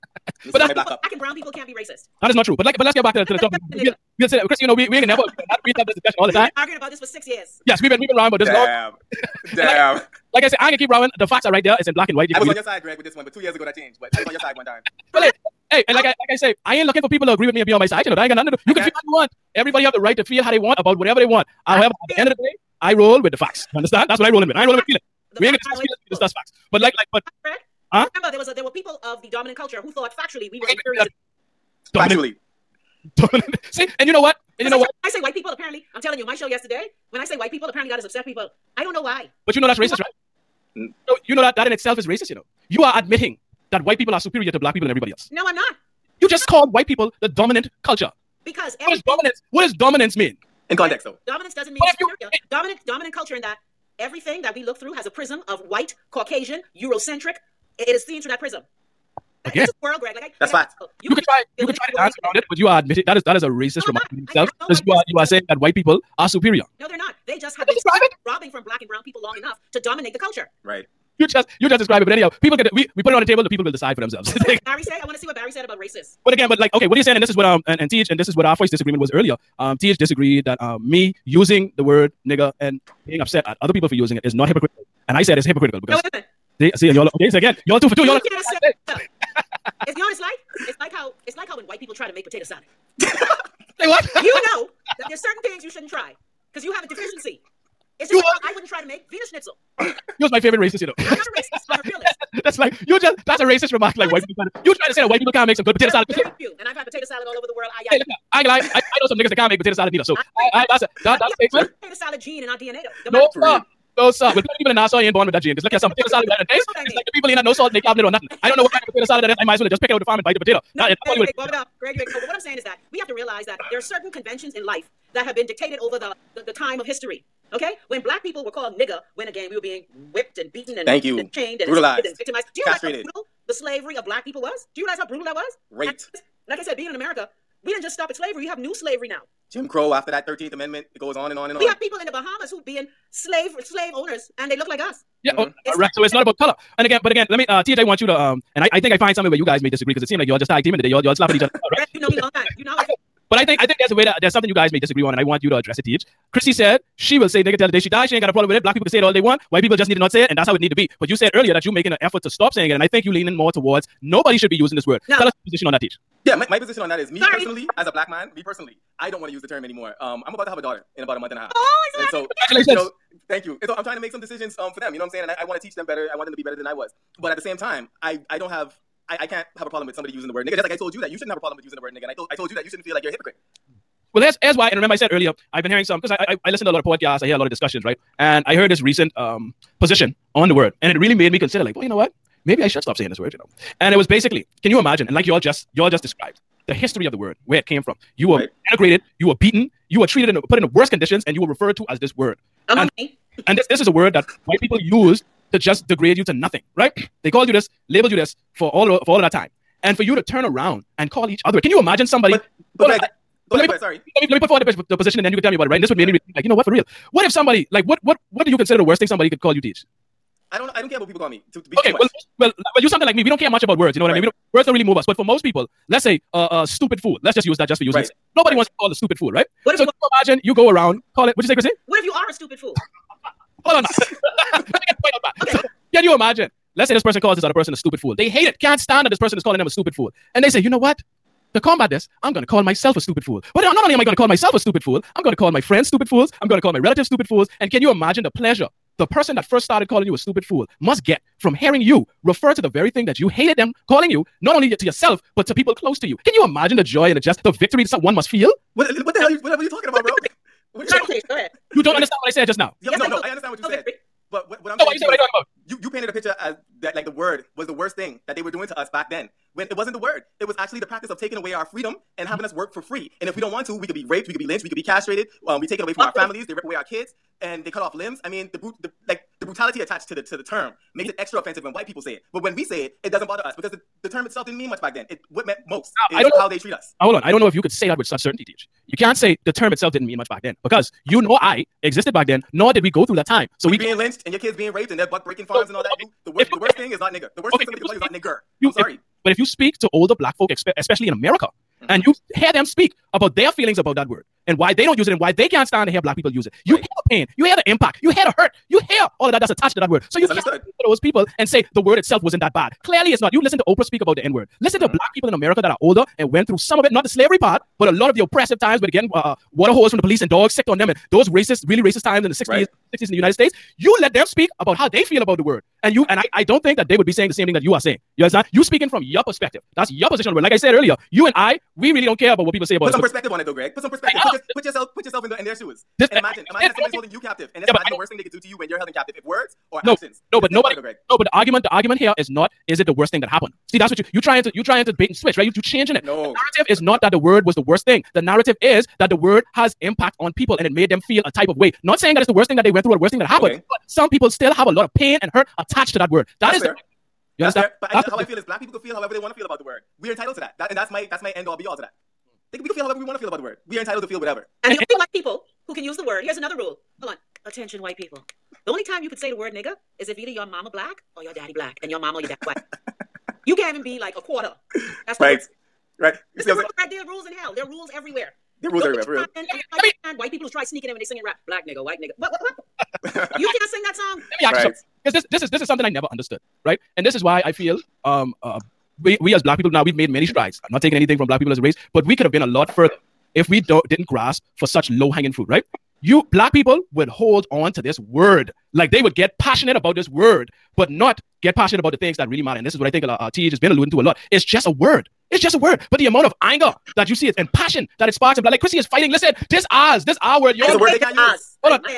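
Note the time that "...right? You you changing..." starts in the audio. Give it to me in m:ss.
5:45.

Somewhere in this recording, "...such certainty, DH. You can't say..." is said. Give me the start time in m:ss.
4:48.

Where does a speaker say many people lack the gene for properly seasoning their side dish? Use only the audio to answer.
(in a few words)
Nassau.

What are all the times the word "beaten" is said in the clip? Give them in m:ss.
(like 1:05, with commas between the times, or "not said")
2:10, 3:19.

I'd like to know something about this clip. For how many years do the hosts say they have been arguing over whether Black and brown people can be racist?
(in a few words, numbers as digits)
6.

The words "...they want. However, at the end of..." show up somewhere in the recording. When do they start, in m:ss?
0:21.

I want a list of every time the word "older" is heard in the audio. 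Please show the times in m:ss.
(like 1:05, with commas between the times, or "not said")
4:59, 5:15.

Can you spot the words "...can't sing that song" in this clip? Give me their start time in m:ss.
6:23.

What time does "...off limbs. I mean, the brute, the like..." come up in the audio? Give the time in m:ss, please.
4:37.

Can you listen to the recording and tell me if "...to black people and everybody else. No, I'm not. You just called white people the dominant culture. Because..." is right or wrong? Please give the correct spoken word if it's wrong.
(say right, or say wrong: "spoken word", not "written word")
right.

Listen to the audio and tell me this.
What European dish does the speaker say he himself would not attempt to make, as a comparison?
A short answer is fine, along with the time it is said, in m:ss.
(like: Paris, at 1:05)
Wiener schnitzel, at 1:39.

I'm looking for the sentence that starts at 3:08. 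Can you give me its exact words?
And I heard this recent um, position on the word.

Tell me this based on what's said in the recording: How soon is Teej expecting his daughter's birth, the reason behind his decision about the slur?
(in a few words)
A month and a half.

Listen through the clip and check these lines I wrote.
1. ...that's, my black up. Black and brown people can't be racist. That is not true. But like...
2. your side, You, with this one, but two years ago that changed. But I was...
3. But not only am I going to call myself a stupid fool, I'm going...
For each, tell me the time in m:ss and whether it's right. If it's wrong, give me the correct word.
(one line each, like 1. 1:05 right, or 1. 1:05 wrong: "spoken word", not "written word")
1. 0:00 right
2. 0:12 wrong: "Greg", not "You"
3. 4:03 right.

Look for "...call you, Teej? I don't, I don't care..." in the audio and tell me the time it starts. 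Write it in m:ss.
3:39.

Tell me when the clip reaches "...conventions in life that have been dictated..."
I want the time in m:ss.
2:04.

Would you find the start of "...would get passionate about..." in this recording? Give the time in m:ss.
6:39.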